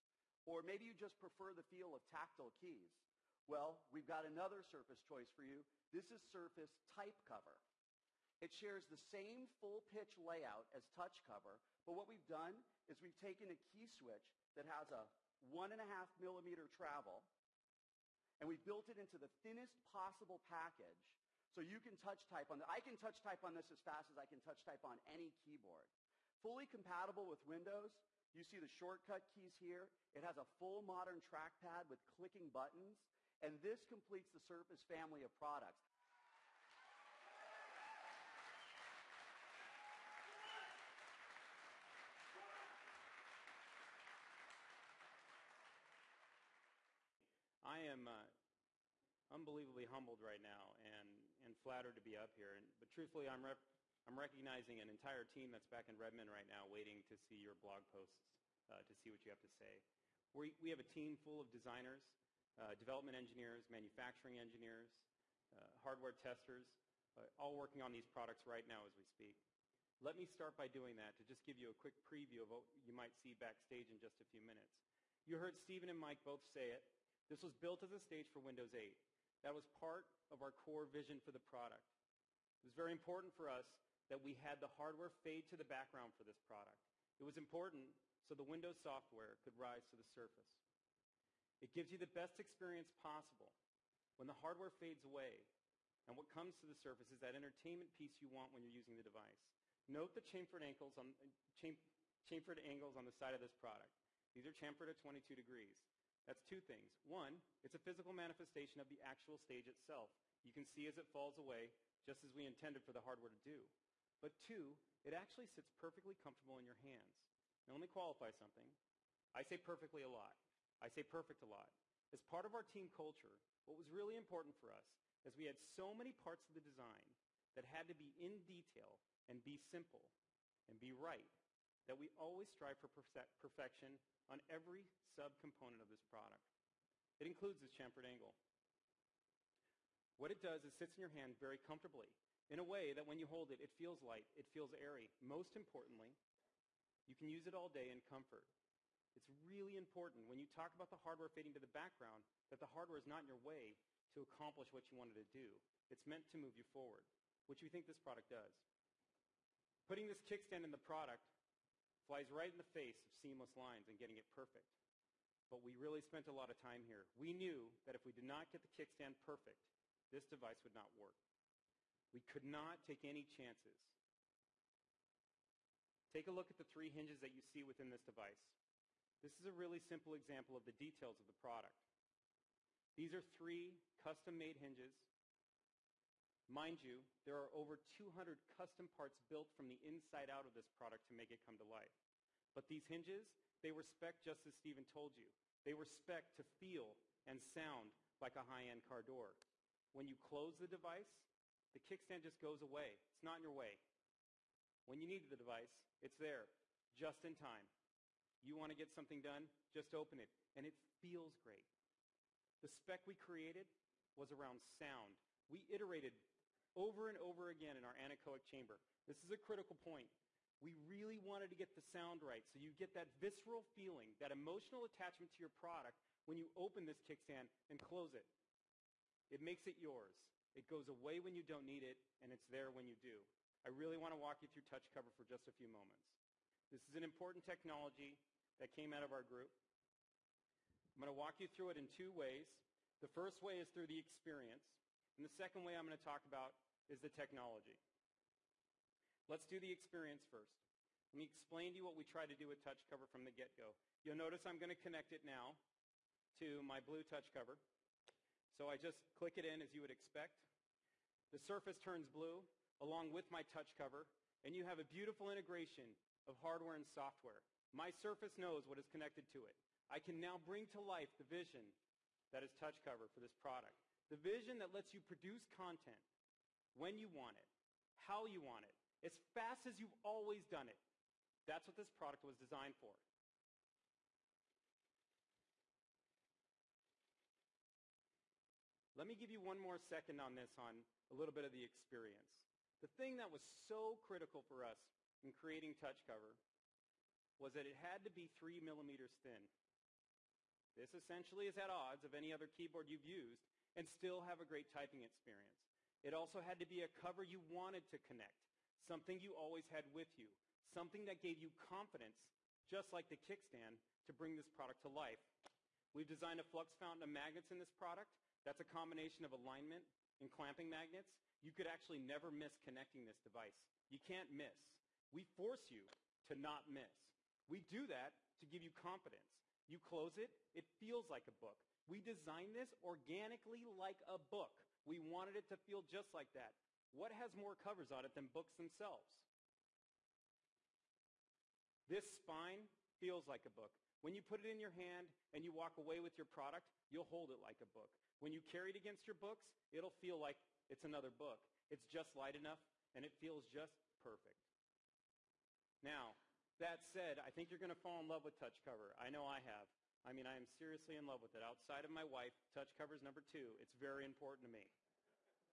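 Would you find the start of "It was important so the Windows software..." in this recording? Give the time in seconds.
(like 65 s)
87 s.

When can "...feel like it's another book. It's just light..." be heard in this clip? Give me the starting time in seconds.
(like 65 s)
349 s.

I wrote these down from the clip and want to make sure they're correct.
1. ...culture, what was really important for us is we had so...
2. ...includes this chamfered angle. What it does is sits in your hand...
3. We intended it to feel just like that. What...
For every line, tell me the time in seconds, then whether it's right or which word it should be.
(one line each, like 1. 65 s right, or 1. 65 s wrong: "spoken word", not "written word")
1. 122 s right
2. 137 s right
3. 334 s wrong: "wanted", not "intended".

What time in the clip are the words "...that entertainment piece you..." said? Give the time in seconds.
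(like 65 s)
97 s.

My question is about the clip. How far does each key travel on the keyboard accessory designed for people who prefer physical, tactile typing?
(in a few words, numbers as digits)
1.5 millimeters.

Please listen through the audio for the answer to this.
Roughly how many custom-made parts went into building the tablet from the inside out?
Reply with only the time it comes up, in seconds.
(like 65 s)
187 s.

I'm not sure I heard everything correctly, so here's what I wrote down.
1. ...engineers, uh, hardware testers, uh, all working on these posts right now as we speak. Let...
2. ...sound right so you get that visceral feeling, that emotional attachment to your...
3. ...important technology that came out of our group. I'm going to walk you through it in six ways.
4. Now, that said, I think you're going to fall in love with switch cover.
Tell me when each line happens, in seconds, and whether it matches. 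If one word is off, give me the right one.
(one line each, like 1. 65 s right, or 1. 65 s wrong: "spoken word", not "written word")
1. 64 s wrong: "products", not "posts"
2. 221 s right
3. 237 s wrong: "two", not "six"
4. 355 s wrong: "touch", not "switch".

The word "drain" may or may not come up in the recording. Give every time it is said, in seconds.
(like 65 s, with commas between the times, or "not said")
not said.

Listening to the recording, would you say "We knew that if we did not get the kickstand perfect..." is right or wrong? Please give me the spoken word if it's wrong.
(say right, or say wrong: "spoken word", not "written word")
right.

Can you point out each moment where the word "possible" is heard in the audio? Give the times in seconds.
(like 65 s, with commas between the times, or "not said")
19 s, 92 s.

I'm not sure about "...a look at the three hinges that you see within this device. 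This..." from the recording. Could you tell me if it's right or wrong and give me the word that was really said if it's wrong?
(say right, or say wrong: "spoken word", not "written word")
right.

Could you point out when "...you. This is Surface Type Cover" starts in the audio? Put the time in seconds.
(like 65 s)
5 s.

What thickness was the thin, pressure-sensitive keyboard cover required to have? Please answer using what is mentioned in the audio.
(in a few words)
3 millimeters.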